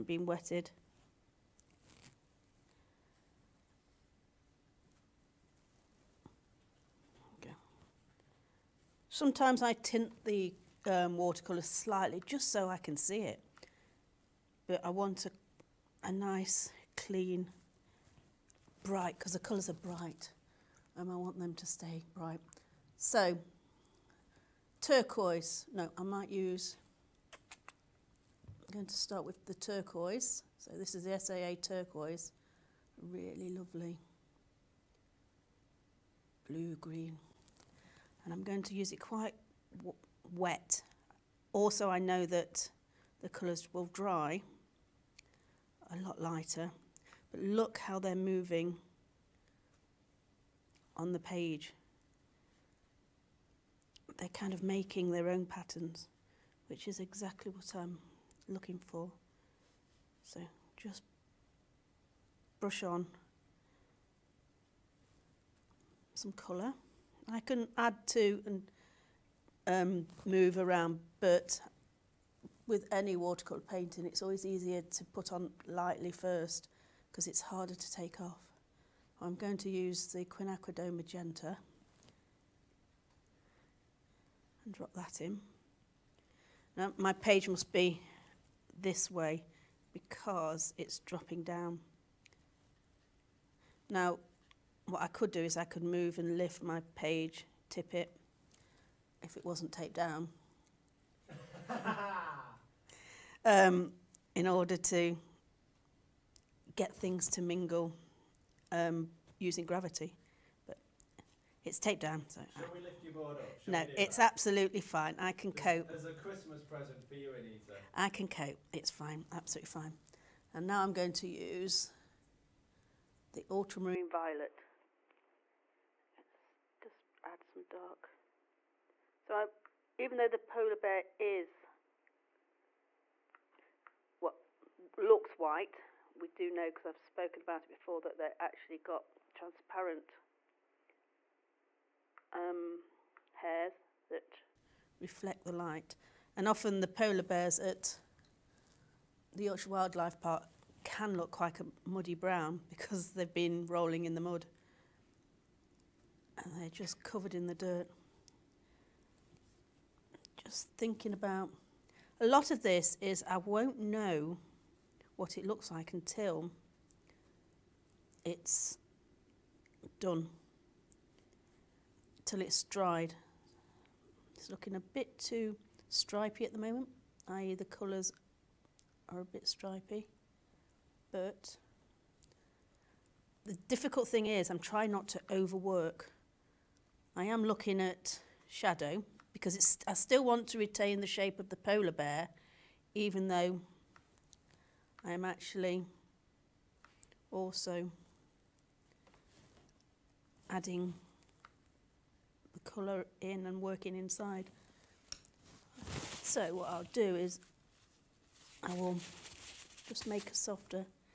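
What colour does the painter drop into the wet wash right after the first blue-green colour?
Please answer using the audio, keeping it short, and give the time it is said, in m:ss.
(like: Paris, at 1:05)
Quinacridone magenta, at 1:20.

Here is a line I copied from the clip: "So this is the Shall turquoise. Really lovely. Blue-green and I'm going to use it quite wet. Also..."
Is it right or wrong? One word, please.
wrong.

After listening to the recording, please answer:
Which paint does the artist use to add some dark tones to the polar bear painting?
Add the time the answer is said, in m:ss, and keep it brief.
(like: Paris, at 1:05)
Ultramarine violet, at 2:03.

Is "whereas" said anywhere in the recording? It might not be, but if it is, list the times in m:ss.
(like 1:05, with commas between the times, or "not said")
not said.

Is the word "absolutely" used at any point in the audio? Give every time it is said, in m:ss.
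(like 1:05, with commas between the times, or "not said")
1:54, 1:59.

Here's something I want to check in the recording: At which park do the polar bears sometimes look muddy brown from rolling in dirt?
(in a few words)
Yorkshire Wildlife Park.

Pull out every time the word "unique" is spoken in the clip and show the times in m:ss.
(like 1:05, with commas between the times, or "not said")
not said.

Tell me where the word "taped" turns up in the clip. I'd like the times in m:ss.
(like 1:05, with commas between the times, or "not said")
1:39, 1:51.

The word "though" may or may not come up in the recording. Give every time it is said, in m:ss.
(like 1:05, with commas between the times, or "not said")
2:10, 3:13.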